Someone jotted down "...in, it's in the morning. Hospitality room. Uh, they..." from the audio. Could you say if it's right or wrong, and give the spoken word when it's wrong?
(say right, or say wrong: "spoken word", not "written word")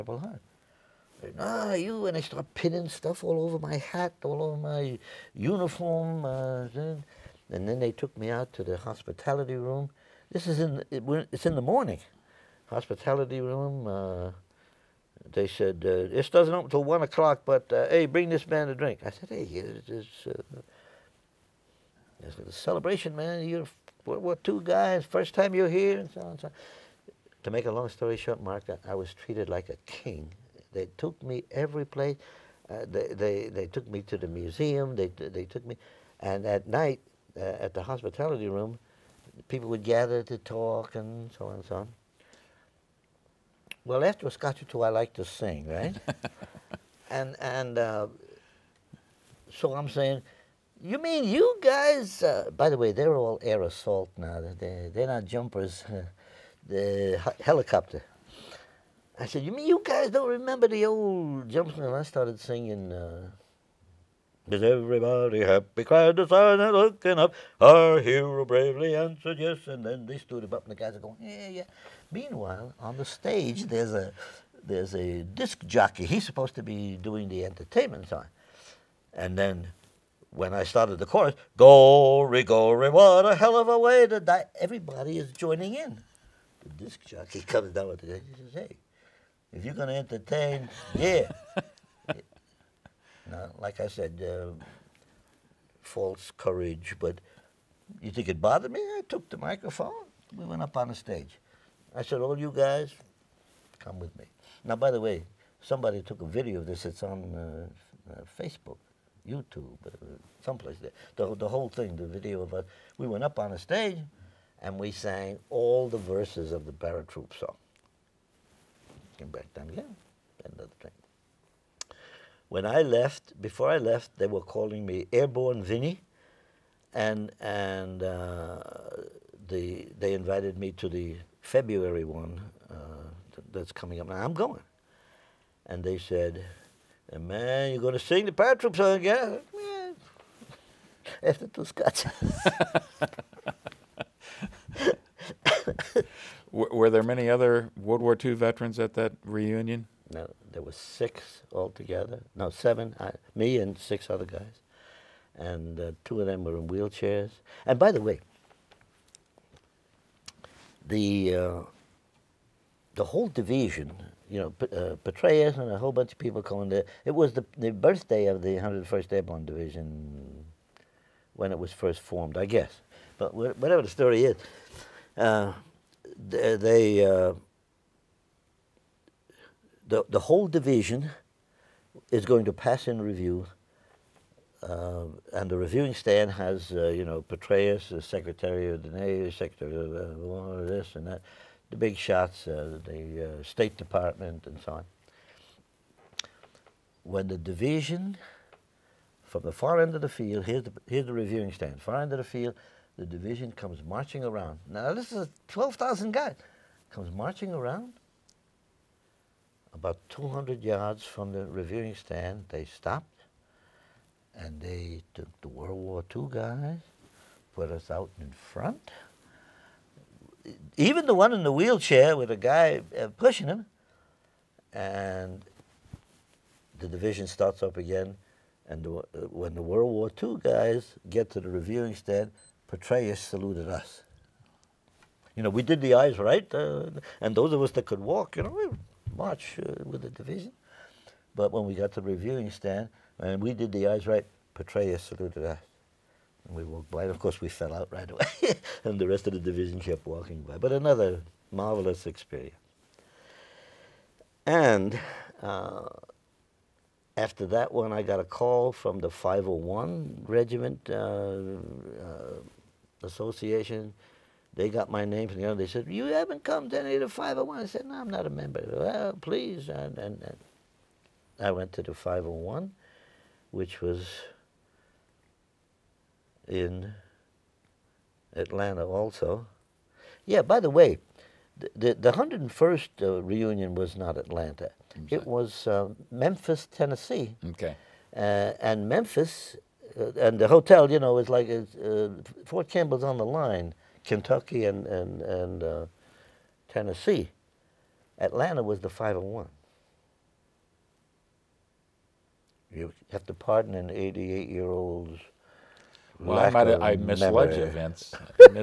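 right.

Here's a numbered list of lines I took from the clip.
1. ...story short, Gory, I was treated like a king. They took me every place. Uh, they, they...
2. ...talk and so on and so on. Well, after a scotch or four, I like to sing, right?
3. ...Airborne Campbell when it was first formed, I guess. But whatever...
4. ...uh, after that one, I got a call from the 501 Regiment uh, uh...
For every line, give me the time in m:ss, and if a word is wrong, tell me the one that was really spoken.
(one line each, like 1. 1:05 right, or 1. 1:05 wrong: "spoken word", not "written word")
1. 0:27 wrong: "Mark", not "Gory"
2. 0:40 wrong: "two", not "four"
3. 2:49 wrong: "Division", not "Campbell"
4. 4:15 right.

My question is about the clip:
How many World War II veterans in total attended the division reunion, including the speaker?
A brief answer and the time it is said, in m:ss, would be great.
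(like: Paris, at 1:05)
7, at 2:32.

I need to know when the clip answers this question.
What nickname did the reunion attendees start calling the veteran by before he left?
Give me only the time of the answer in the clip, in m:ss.
2:05.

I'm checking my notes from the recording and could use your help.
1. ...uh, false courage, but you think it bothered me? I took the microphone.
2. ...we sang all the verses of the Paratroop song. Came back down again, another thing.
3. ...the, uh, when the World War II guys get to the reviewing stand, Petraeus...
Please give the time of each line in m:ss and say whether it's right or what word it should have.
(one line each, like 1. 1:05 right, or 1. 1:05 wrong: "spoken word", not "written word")
1. 1:34 right
2. 1:54 right
3. 3:48 right.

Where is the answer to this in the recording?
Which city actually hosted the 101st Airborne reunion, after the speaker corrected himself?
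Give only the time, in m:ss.
4:46.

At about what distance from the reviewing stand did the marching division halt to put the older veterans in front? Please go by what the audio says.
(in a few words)
200 yards.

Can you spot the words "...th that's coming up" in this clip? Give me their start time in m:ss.
2:13.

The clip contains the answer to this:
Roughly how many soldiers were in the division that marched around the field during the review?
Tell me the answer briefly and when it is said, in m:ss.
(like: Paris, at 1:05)
12,000, at 3:25.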